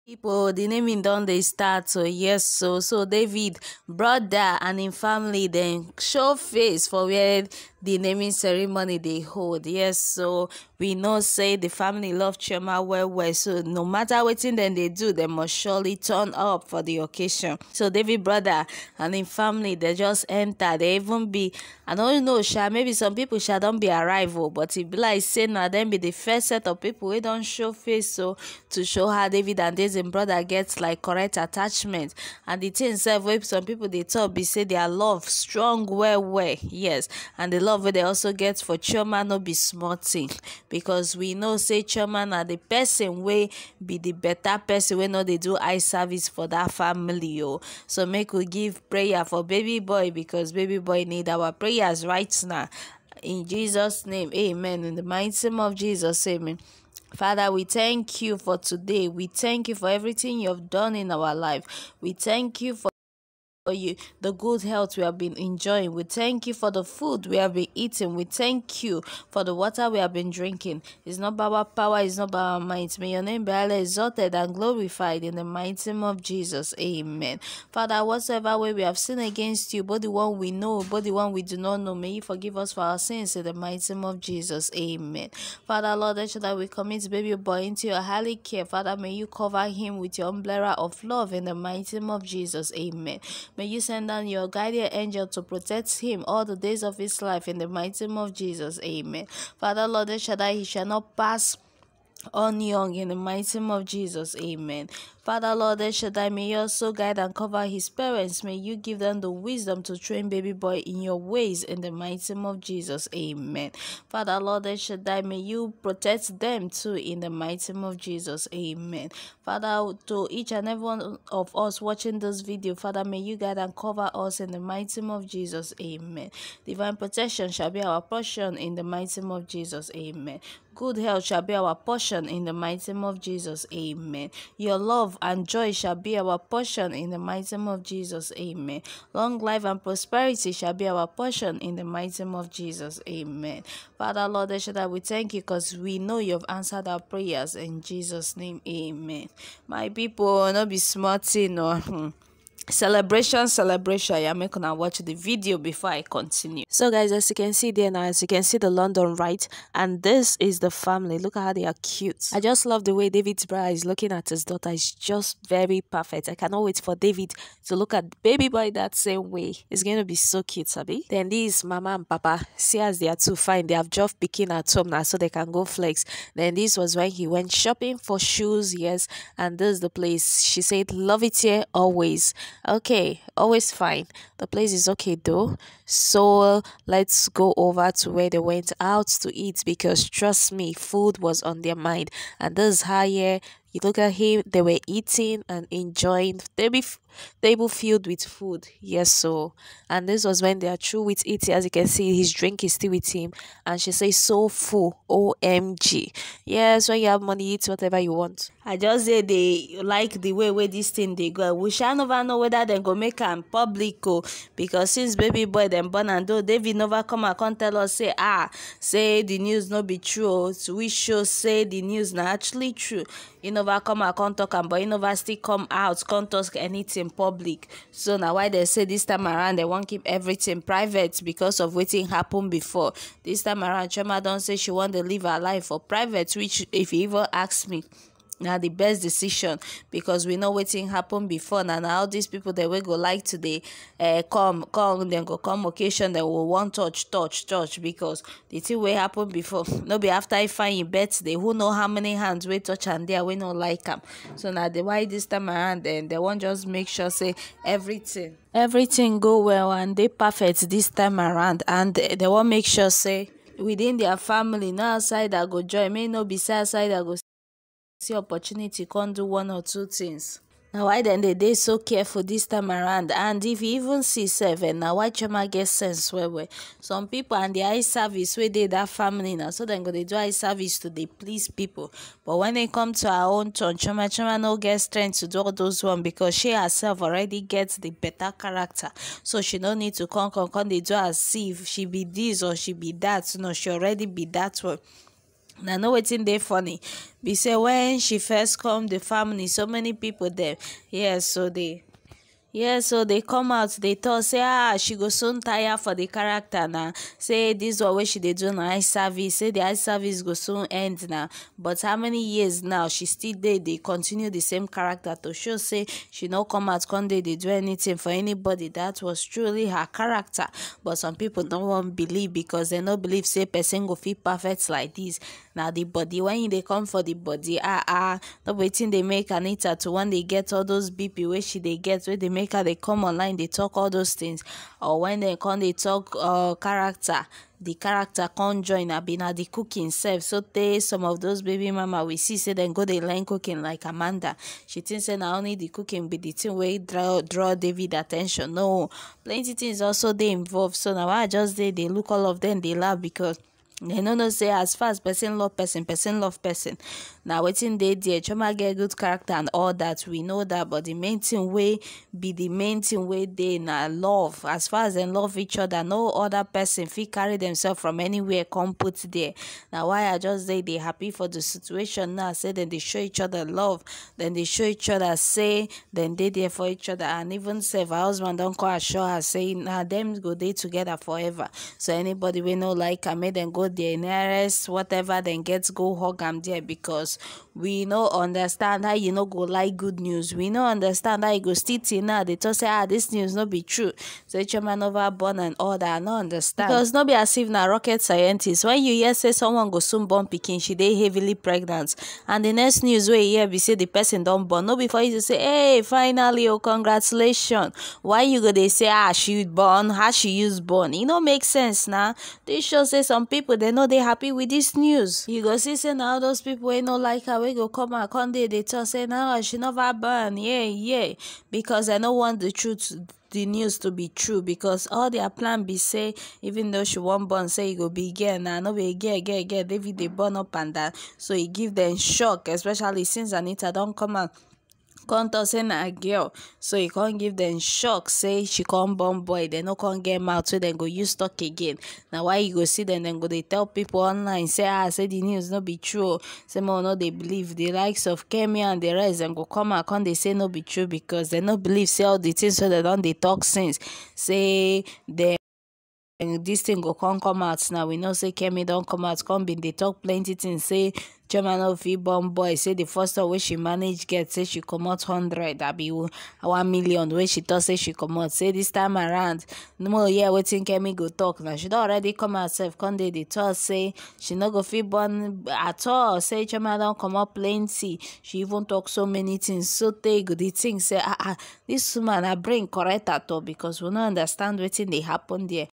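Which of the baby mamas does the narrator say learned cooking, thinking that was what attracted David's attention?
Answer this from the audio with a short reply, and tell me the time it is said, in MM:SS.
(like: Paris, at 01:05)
Amanda, at 05:43.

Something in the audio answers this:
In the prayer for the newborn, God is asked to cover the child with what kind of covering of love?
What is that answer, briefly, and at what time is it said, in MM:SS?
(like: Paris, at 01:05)
umbrella, at 01:30.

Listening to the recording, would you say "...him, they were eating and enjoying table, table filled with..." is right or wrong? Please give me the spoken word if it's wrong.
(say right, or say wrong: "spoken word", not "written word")
right.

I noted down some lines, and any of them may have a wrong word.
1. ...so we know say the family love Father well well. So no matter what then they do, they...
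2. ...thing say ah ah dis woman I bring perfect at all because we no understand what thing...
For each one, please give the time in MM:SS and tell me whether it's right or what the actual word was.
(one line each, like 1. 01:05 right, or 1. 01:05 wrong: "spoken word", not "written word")
1. 00:09 wrong: "Chioma", not "Father"
2. 08:00 wrong: "correct", not "perfect".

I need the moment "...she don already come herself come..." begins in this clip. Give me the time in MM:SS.
07:51.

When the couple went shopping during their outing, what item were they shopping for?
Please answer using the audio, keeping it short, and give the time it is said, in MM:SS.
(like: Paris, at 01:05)
shoes, at 02:58.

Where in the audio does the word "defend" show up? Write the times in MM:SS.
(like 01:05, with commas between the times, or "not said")
not said.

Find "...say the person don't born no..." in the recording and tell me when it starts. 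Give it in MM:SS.
06:43.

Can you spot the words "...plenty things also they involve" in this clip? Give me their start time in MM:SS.
05:49.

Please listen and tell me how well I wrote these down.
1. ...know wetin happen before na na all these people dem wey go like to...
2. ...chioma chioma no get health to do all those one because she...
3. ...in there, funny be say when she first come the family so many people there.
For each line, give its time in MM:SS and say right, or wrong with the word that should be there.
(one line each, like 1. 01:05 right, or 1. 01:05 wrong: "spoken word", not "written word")
1. 04:00 right
2. 04:43 wrong: "strength", not "health"
3. 04:56 right.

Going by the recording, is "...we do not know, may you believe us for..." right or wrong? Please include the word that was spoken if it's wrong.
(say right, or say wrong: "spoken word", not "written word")
wrong: "forgive", not "believe".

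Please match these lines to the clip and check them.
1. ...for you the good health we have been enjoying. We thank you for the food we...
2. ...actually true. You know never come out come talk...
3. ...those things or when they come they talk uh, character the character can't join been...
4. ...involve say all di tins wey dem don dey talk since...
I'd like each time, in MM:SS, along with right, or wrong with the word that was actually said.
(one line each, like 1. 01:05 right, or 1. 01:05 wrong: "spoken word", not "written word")
1. 01:03 right
2. 03:42 right
3. 05:33 right
4. 07:31 wrong: "believe", not "involve".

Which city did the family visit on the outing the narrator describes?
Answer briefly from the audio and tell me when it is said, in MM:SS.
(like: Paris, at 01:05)
London, at 02:38.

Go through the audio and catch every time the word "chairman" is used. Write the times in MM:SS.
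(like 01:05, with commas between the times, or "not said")
07:41, 07:56.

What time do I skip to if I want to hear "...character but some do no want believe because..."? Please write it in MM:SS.
05:19.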